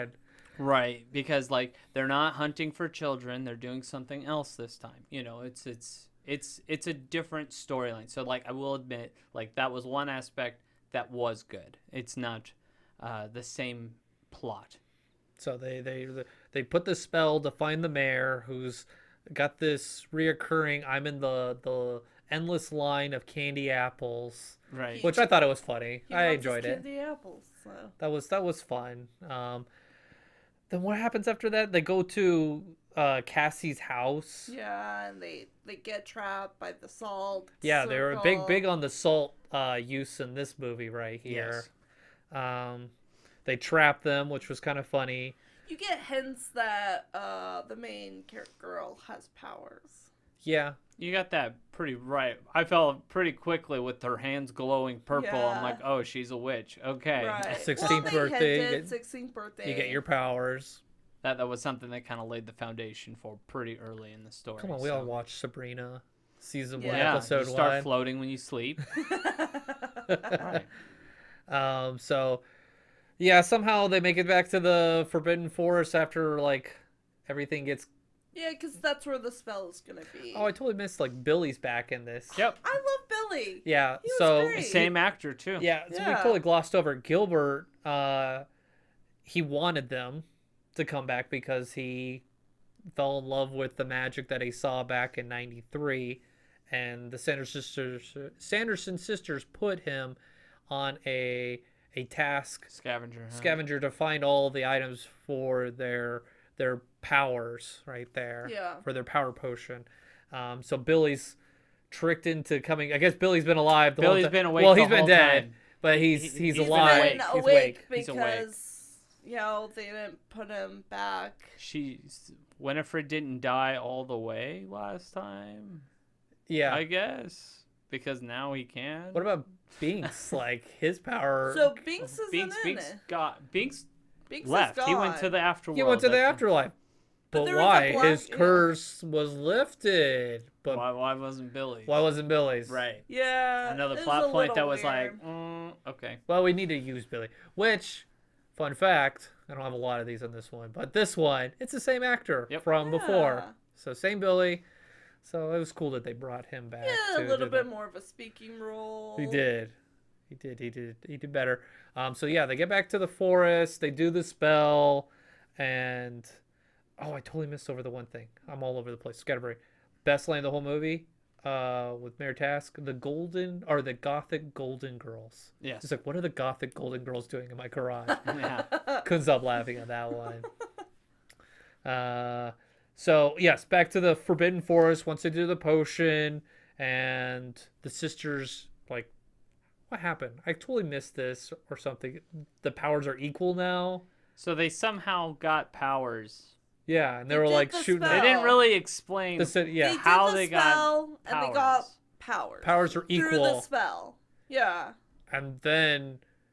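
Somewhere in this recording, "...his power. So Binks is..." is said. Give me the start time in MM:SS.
02:10.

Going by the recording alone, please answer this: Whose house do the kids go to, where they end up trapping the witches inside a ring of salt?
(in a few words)
Cassie's.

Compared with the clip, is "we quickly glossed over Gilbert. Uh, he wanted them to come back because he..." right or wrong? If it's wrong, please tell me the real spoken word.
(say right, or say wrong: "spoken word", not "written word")
wrong: "totally", not "quickly".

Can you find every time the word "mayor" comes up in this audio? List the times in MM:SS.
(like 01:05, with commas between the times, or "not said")
00:17, 02:52.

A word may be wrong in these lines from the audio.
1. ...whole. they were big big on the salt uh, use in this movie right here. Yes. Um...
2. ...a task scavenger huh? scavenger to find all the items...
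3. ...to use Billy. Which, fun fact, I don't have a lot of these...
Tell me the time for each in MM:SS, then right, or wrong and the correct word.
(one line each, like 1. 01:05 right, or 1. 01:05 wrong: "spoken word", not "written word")
1. 00:37 wrong: "circle", not "whole"
2. 01:41 right
3. 02:26 right.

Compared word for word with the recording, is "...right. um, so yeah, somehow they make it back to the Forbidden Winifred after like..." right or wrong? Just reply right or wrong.
wrong.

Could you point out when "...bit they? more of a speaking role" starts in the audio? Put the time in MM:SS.
02:37.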